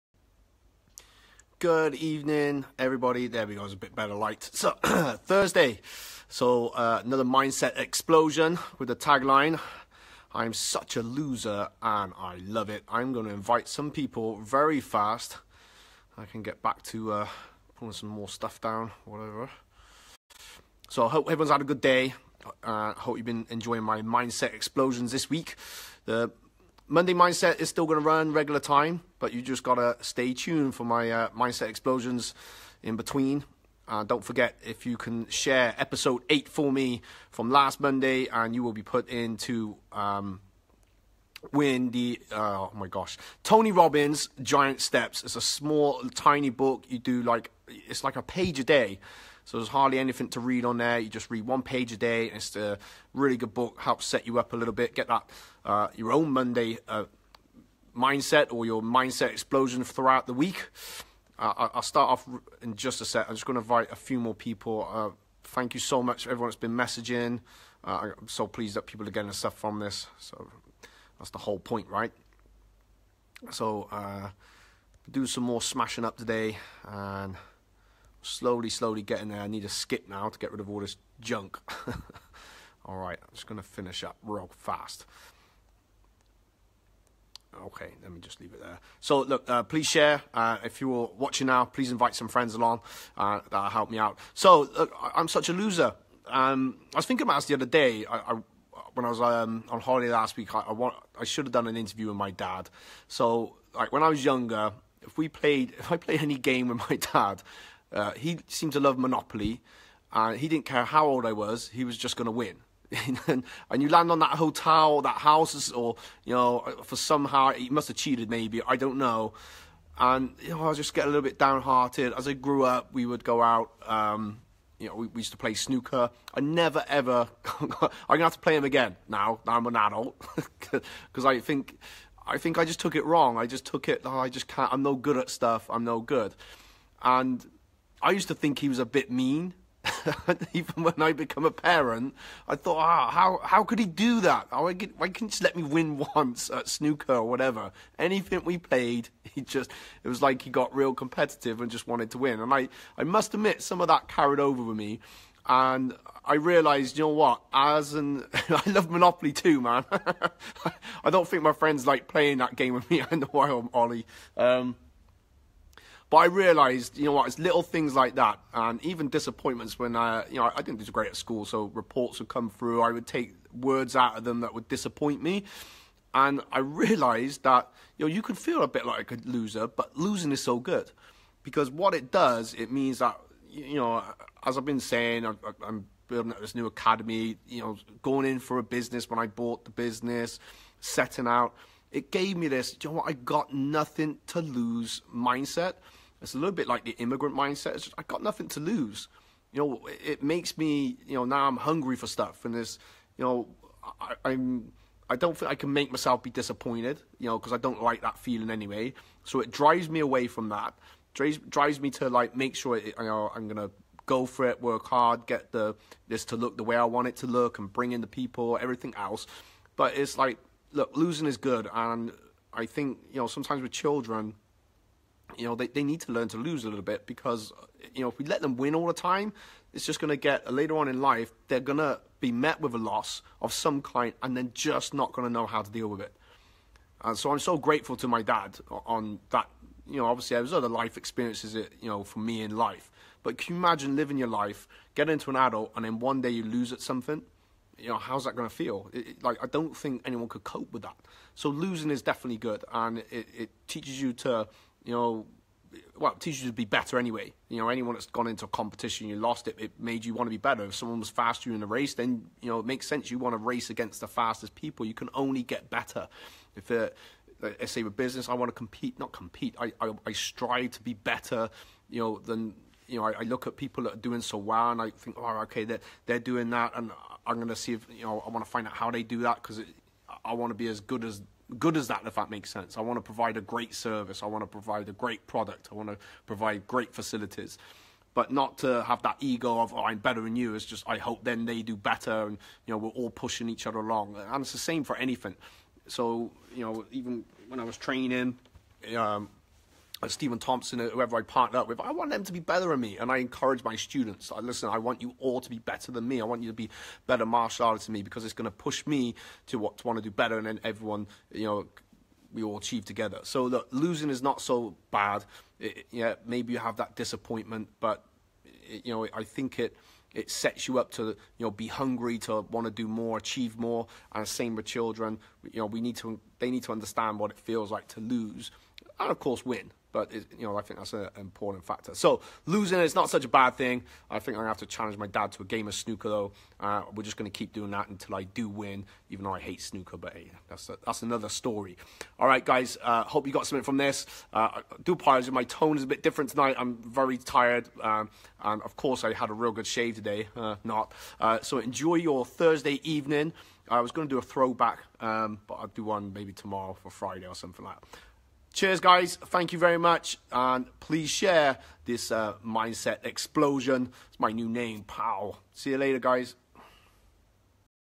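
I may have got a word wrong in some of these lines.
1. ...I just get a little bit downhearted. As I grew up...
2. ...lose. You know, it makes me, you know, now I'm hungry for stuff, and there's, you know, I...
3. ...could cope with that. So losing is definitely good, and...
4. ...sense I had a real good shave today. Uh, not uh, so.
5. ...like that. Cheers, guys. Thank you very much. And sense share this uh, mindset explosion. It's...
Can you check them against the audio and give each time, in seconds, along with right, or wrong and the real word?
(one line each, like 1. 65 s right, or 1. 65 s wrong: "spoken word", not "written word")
1. 120 s right
2. 198 s right
3. 250 s right
4. 348 s wrong: "course", not "sense"
5. 357 s wrong: "please", not "sense".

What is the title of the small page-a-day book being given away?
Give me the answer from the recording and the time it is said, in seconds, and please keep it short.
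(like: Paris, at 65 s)
Giant Steps, at 44 s.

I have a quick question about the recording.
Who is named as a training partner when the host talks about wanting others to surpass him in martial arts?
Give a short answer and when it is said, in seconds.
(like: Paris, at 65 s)
Stephen Thompson, at 300 s.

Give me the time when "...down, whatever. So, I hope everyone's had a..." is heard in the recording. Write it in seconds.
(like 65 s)
18 s.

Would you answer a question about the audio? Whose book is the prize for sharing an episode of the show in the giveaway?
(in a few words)
Tony Robbins.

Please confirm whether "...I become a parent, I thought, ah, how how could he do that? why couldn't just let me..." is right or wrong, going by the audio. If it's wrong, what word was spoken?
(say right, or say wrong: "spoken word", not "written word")
right.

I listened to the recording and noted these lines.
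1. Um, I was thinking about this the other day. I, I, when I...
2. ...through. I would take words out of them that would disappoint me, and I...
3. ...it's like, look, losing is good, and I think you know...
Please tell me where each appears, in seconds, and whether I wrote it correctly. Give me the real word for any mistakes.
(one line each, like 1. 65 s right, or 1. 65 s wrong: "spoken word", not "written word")
1. 96 s right
2. 172 s right
3. 219 s right.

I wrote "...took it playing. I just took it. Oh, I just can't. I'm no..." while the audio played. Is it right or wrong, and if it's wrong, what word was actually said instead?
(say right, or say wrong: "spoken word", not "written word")
wrong: "wrong", not "playing".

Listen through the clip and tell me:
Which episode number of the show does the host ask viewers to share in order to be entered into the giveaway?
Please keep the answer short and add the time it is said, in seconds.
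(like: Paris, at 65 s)
8, at 35 s.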